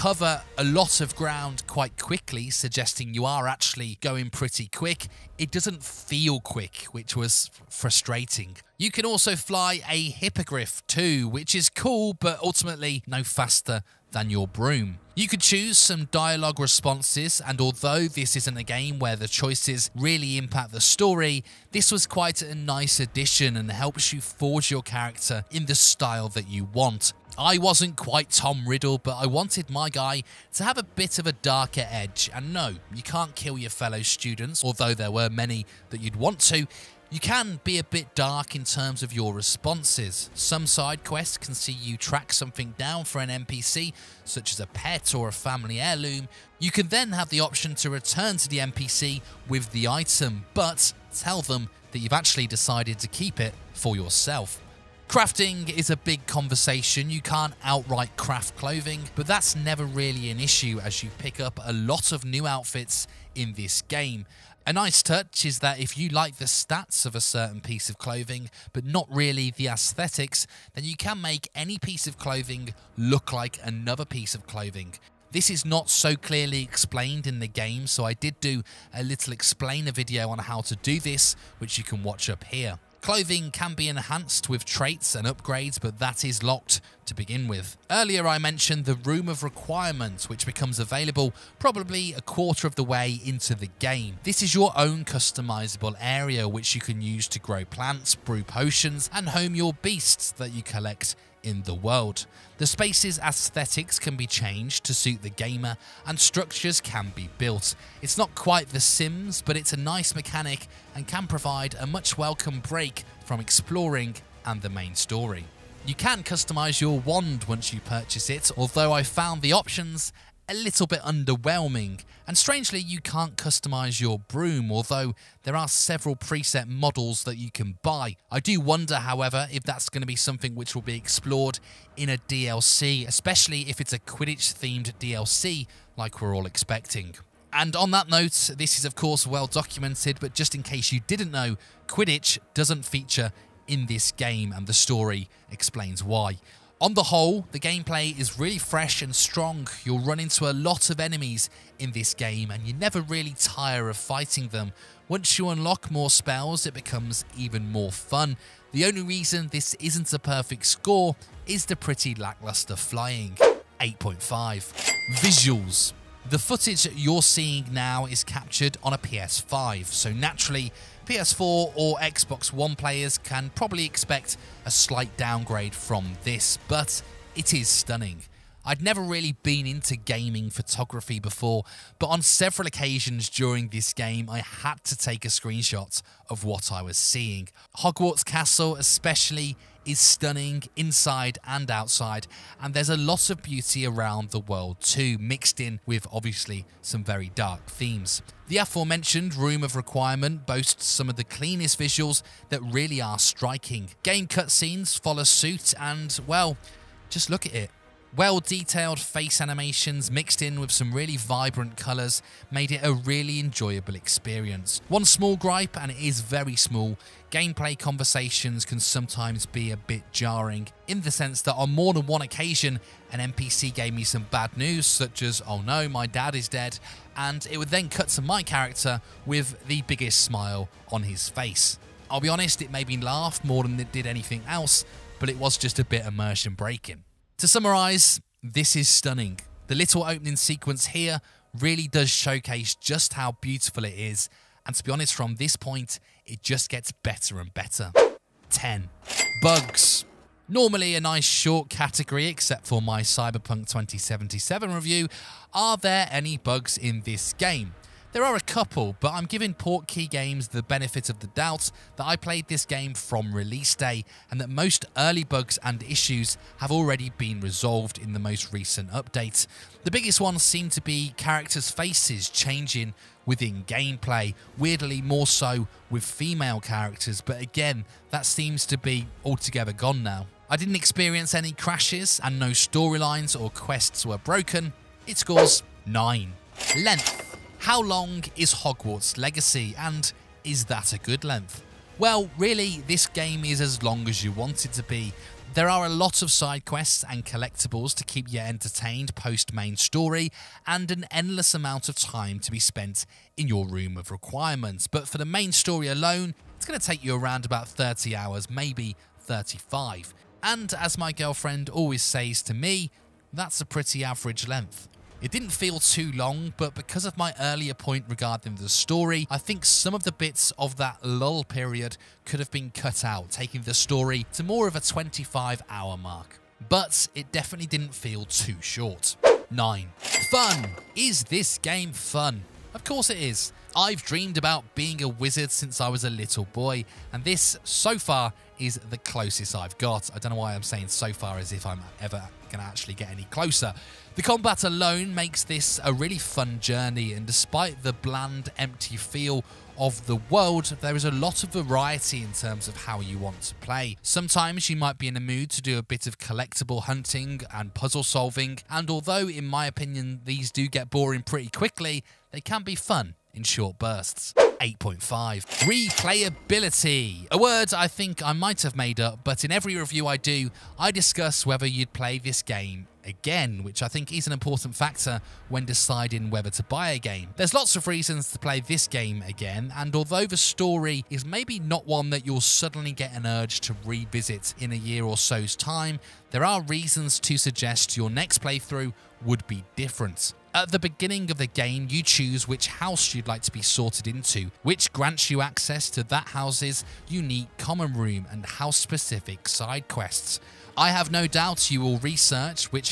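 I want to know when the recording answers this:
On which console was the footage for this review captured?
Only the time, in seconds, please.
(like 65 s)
168 s.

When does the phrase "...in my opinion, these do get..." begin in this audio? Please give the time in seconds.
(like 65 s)
359 s.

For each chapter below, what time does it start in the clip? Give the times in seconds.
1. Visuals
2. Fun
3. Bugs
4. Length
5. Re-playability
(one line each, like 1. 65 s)
1. 164 s
2. 329 s
3. 248 s
4. 286 s
5. 365 s.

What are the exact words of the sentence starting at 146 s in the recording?
On the whole, the gameplay is really fresh and strong.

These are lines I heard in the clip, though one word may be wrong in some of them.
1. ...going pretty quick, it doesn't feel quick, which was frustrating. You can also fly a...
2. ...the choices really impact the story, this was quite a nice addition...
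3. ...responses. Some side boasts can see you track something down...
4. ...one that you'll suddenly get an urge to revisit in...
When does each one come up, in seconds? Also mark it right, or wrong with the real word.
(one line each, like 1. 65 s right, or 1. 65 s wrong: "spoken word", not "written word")
1. 3 s right
2. 19 s right
3. 39 s wrong: "quests", not "boasts"
4. 381 s right.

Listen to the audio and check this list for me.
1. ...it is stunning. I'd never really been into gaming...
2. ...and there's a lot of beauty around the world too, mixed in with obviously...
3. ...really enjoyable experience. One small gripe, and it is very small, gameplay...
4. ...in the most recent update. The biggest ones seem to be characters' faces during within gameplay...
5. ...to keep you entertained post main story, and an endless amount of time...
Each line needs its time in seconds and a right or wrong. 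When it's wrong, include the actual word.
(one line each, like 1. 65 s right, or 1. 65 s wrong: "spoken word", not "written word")
1. 177 s right
2. 192 s right
3. 212 s right
4. 267 s wrong: "changing", not "during"
5. 297 s right.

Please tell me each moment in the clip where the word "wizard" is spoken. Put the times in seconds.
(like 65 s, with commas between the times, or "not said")
335 s.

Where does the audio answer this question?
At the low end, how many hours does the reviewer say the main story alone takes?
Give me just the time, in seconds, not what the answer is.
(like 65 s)
307 s.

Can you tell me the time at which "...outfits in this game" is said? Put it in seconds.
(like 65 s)
62 s.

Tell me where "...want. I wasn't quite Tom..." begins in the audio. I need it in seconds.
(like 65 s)
26 s.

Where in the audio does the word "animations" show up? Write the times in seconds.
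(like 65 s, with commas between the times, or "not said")
209 s.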